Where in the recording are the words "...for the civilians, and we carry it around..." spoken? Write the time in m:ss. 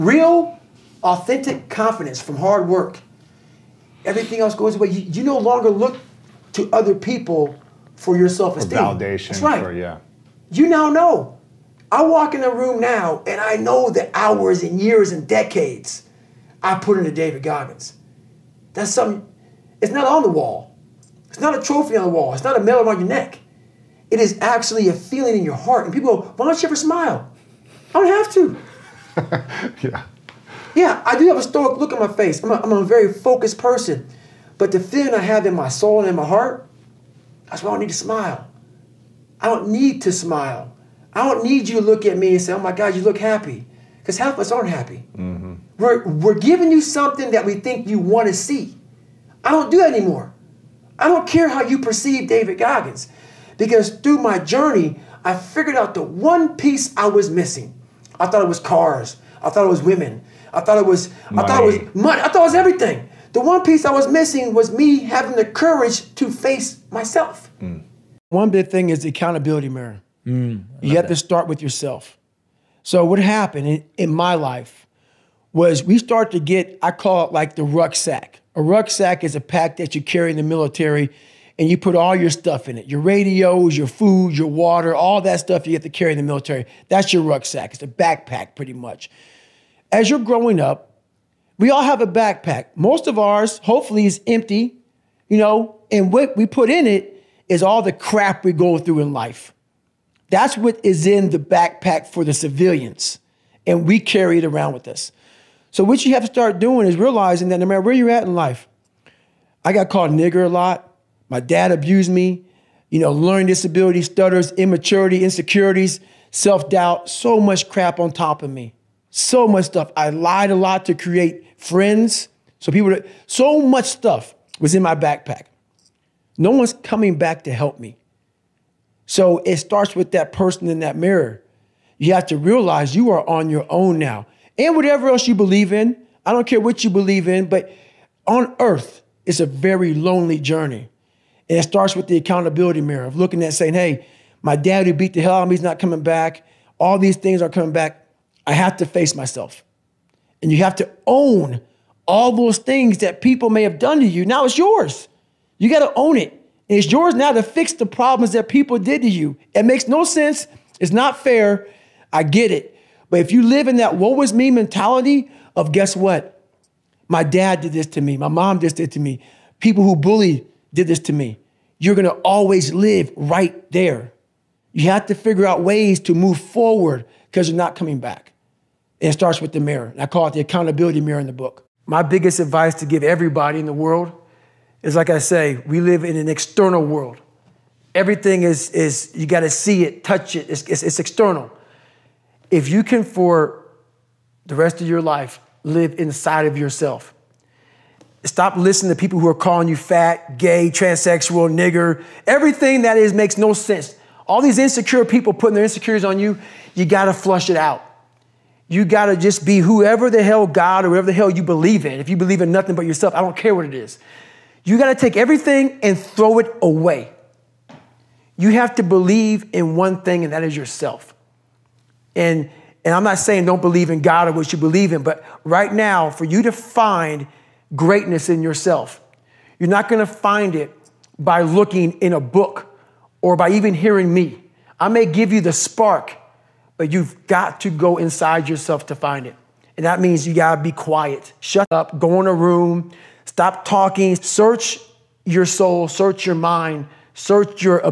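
1:42.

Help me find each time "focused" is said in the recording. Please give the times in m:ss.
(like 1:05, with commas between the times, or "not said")
0:33.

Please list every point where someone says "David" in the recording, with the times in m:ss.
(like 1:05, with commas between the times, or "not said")
0:17, 0:52.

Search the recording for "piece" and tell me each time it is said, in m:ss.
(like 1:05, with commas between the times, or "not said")
0:56, 1:03.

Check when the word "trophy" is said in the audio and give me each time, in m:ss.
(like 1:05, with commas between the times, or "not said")
0:21.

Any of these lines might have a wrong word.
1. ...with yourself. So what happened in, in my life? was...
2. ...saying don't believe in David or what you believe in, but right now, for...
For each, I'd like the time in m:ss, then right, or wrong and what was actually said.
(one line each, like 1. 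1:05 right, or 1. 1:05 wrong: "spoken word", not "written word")
1. 1:11 right
2. 3:43 wrong: "God", not "David".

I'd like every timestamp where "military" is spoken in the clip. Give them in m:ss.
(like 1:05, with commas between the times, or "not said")
1:20, 1:26.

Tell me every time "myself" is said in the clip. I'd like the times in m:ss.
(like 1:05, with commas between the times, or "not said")
1:06, 2:29.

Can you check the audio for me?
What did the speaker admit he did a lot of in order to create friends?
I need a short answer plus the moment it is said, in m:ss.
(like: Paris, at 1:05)
lied, at 2:00.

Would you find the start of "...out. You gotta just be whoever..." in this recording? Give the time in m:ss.
3:27.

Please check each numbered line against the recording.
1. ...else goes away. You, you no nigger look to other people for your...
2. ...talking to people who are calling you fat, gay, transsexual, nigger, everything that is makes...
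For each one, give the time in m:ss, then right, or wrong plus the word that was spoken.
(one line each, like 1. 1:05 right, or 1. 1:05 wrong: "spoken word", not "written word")
1. 0:04 wrong: "longer", not "nigger"
2. 3:18 wrong: "listening", not "talking".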